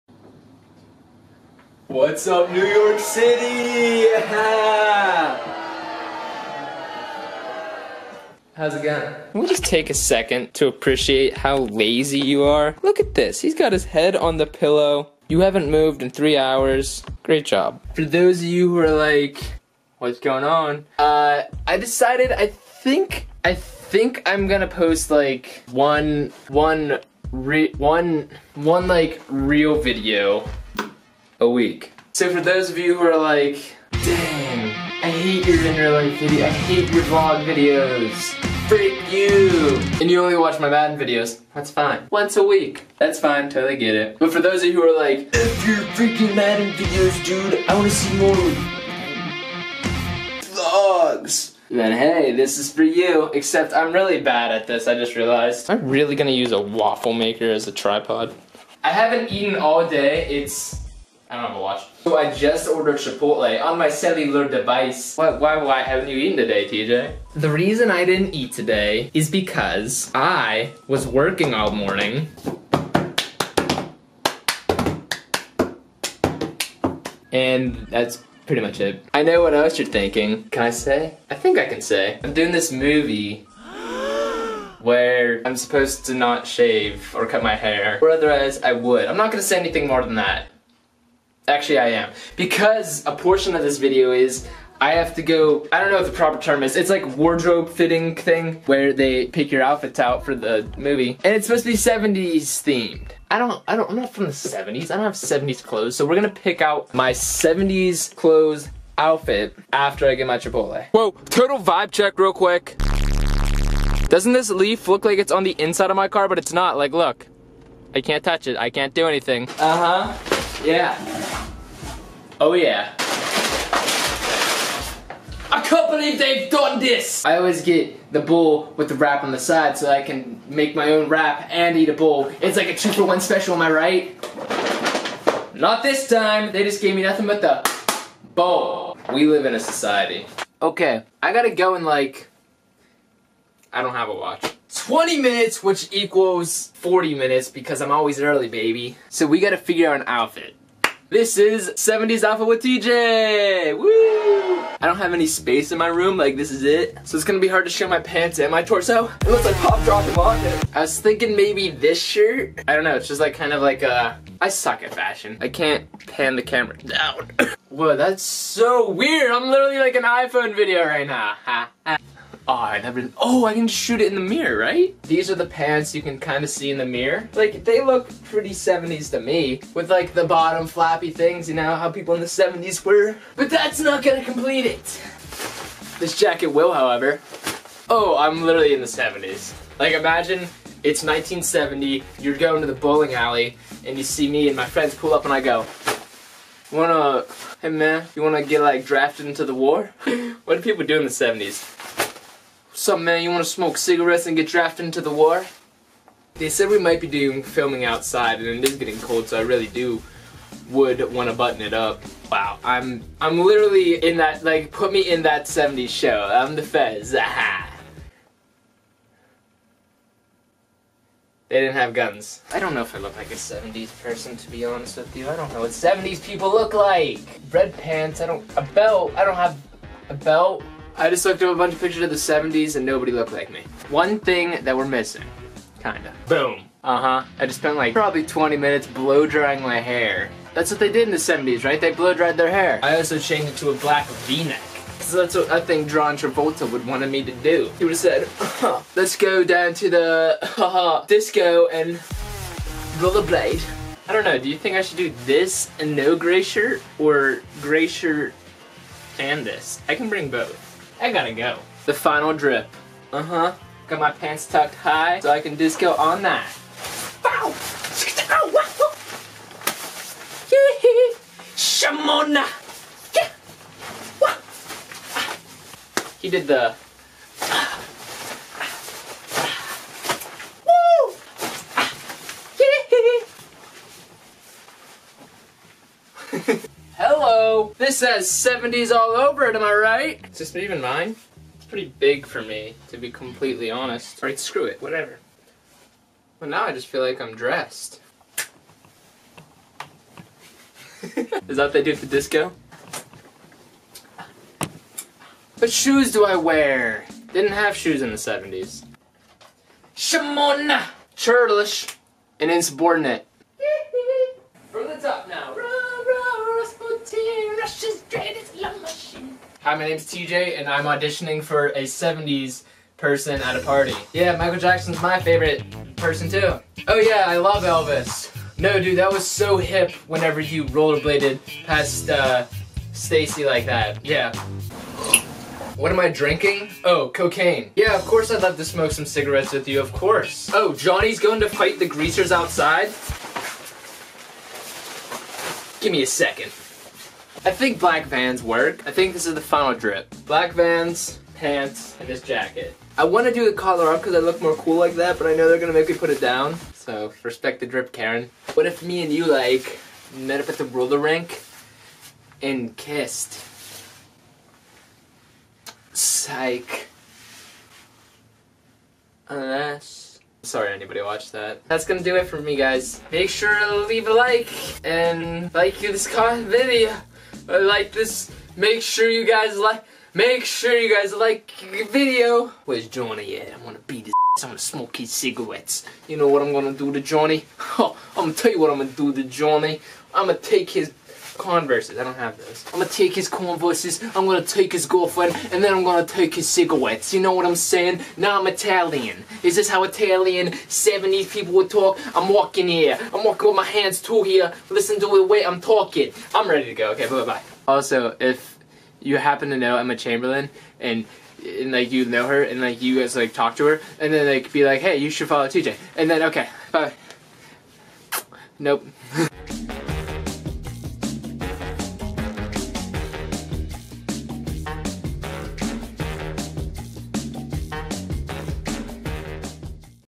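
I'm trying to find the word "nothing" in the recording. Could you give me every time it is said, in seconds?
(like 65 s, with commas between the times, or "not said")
137 s.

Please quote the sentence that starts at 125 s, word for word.
I can't believe they've done this!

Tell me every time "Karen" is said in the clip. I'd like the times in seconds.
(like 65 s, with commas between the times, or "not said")
357 s.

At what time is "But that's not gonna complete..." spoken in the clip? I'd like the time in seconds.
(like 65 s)
183 s.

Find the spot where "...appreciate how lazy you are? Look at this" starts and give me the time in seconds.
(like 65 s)
10 s.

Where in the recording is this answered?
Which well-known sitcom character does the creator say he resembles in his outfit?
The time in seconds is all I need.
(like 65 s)
216 s.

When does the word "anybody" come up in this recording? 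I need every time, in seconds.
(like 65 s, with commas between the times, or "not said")
370 s.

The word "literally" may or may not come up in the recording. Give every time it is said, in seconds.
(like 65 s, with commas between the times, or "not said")
169 s, 188 s, 213 s.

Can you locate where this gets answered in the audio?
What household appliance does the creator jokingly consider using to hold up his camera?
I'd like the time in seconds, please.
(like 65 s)
56 s.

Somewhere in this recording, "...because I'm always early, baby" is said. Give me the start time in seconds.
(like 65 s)
147 s.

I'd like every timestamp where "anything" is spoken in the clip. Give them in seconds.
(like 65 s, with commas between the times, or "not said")
89 s, 119 s.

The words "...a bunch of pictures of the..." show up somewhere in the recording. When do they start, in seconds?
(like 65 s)
231 s.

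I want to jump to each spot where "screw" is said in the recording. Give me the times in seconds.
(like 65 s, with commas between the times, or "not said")
294 s.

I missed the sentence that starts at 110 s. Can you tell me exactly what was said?
Whoa, total vibe check real quick.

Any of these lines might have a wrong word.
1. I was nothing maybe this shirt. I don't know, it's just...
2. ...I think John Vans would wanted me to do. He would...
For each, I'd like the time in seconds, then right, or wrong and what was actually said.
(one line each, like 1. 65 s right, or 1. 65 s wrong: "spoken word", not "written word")
1. 160 s wrong: "thinking", not "nothing"
2. 245 s wrong: "Travolta", not "Vans".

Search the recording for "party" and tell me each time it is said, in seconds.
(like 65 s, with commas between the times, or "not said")
323 s.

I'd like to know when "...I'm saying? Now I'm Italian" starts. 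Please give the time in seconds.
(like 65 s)
397 s.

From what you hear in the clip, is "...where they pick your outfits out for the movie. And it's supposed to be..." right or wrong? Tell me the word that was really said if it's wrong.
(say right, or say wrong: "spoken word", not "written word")
right.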